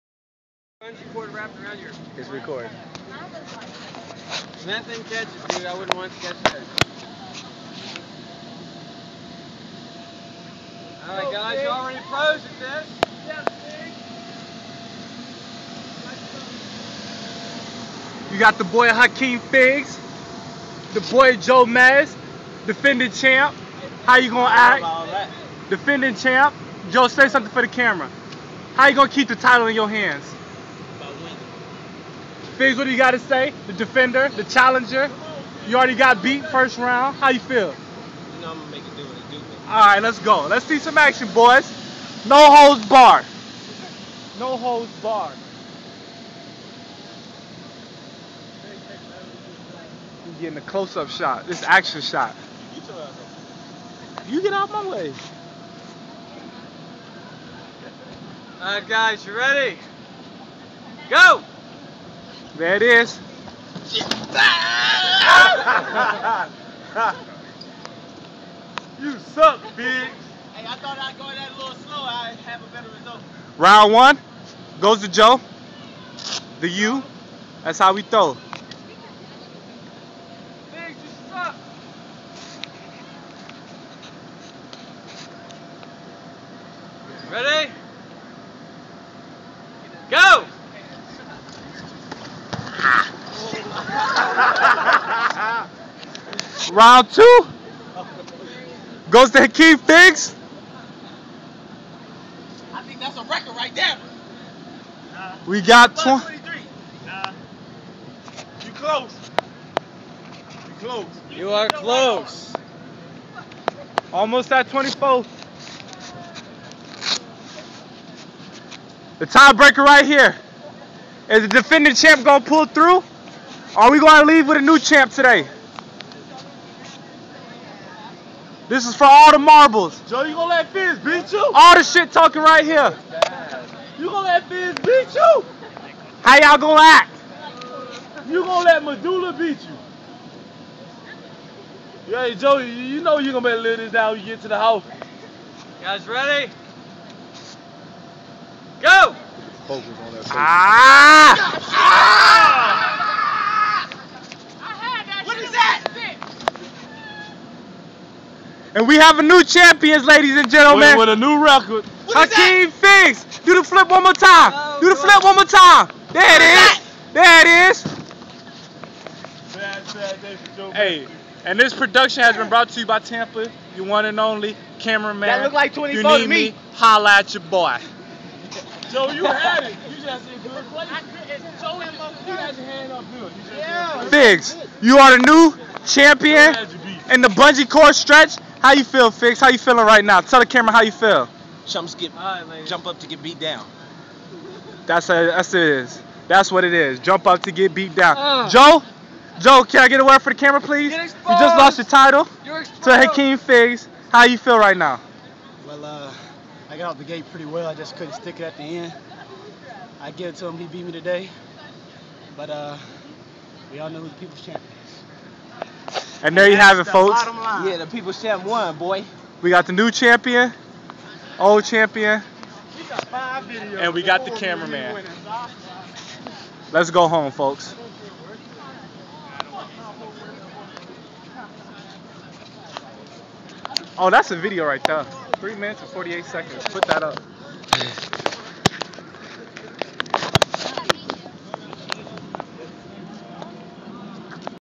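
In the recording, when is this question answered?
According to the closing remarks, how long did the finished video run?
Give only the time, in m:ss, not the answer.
3:55.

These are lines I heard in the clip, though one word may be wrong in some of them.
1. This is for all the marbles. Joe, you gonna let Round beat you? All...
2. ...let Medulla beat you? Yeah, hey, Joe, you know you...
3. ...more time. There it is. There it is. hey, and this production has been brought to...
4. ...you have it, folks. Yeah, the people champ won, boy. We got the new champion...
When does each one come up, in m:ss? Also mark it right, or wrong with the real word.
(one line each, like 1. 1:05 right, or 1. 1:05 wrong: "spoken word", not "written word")
1. 2:08 wrong: "Fizz", not "Round"
2. 2:18 right
3. 2:45 right
4. 3:36 right.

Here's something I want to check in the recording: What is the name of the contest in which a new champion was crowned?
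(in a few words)
bungee cord stretch.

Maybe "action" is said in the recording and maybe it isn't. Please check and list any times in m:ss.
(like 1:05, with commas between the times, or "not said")
0:40, 0:51.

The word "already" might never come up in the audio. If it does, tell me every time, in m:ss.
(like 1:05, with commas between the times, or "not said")
0:11, 0:35.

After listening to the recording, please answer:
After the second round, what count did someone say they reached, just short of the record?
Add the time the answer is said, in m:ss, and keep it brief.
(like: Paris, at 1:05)
23, at 1:45.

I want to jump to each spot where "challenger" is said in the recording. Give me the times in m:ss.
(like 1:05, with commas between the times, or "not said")
0:34.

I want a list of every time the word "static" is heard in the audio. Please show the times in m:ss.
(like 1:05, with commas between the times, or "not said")
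not said.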